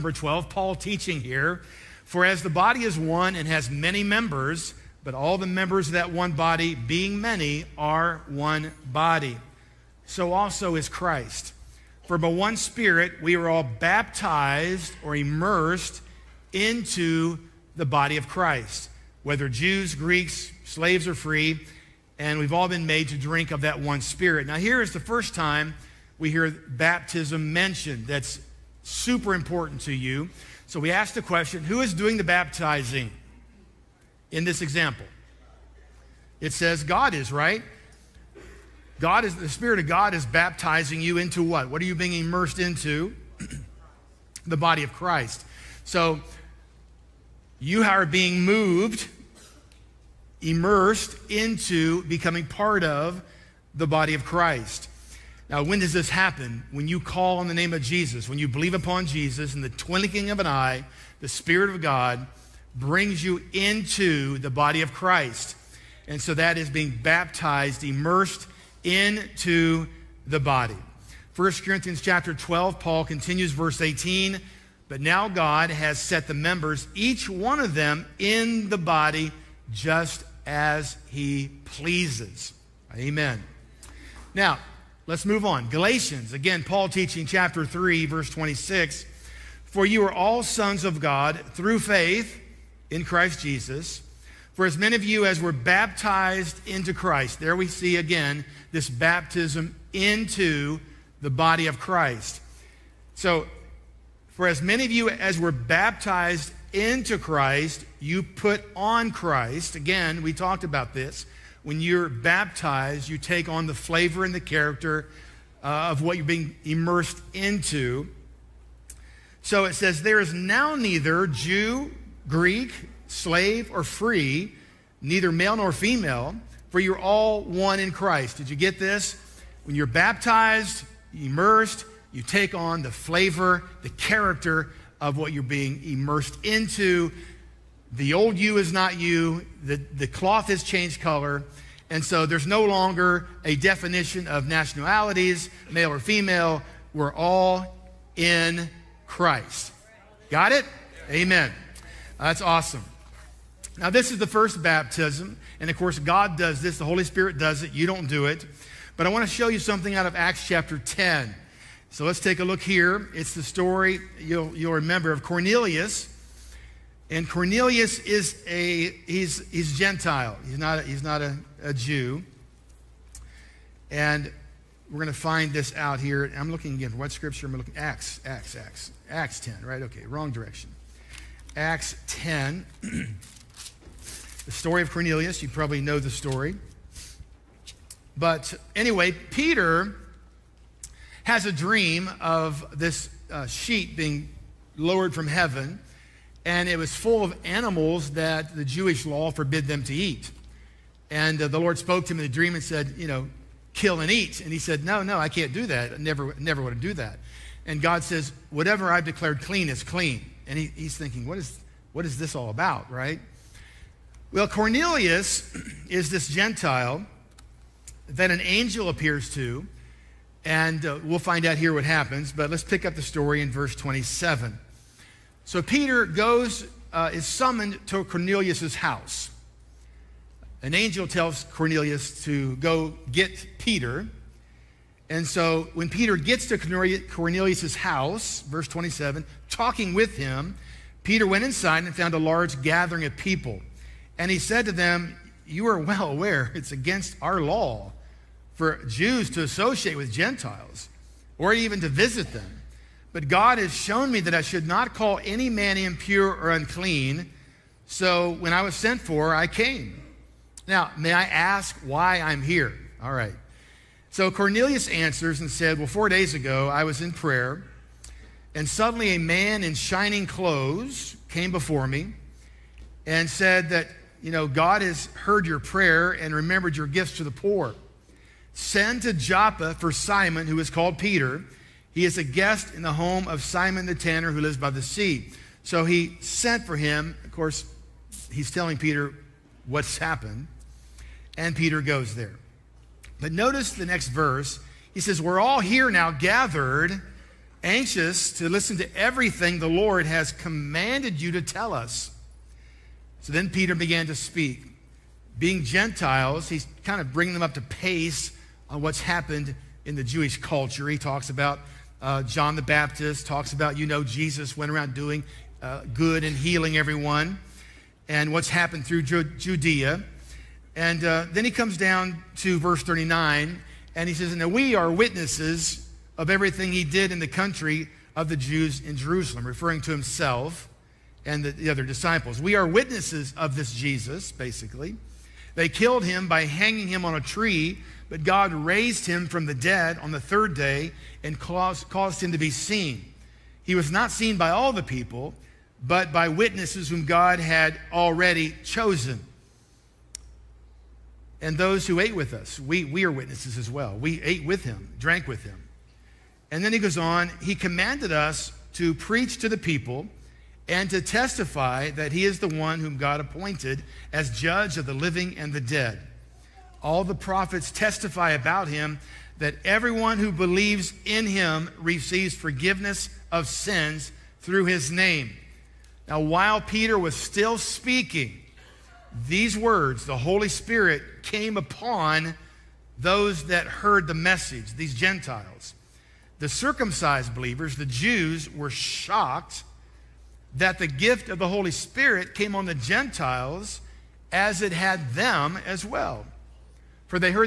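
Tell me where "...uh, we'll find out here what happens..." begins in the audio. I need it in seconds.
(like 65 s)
220 s.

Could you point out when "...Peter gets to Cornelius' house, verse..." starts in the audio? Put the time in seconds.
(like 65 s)
235 s.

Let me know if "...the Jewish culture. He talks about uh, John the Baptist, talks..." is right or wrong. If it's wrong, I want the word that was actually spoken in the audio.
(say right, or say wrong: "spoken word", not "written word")
right.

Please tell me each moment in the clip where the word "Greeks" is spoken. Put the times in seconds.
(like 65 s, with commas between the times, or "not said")
19 s, 122 s.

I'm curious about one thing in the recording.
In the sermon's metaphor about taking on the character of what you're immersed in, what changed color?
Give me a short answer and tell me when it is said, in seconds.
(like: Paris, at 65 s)
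The cloth, at 139 s.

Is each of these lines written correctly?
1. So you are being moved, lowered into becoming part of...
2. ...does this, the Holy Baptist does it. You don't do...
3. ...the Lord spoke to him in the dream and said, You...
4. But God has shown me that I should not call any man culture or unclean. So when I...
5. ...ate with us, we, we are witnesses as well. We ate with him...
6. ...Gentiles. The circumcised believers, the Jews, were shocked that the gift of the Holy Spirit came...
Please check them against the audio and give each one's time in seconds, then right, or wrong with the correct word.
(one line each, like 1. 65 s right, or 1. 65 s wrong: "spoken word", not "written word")
1. 45 s wrong: "immersed", not "lowered"
2. 156 s wrong: "Spirit", not "Baptist"
3. 201 s right
4. 253 s wrong: "impure", not "culture"
5. 351 s right
6. 384 s right.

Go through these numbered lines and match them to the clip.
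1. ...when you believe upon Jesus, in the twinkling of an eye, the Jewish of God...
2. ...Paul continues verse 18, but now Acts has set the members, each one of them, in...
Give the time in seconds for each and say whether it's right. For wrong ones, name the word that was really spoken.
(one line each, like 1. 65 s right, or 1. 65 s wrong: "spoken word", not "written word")
1. 58 s wrong: "Spirit", not "Jewish"
2. 72 s wrong: "God", not "Acts".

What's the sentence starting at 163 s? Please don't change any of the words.
It's the story you'll, you'll remember of Cornelius.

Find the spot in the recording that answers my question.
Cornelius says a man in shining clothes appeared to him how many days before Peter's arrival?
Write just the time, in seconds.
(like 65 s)
265 s.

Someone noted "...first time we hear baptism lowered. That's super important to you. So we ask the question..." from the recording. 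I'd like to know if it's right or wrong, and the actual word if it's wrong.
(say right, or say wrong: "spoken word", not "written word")
wrong: "mentioned", not "lowered".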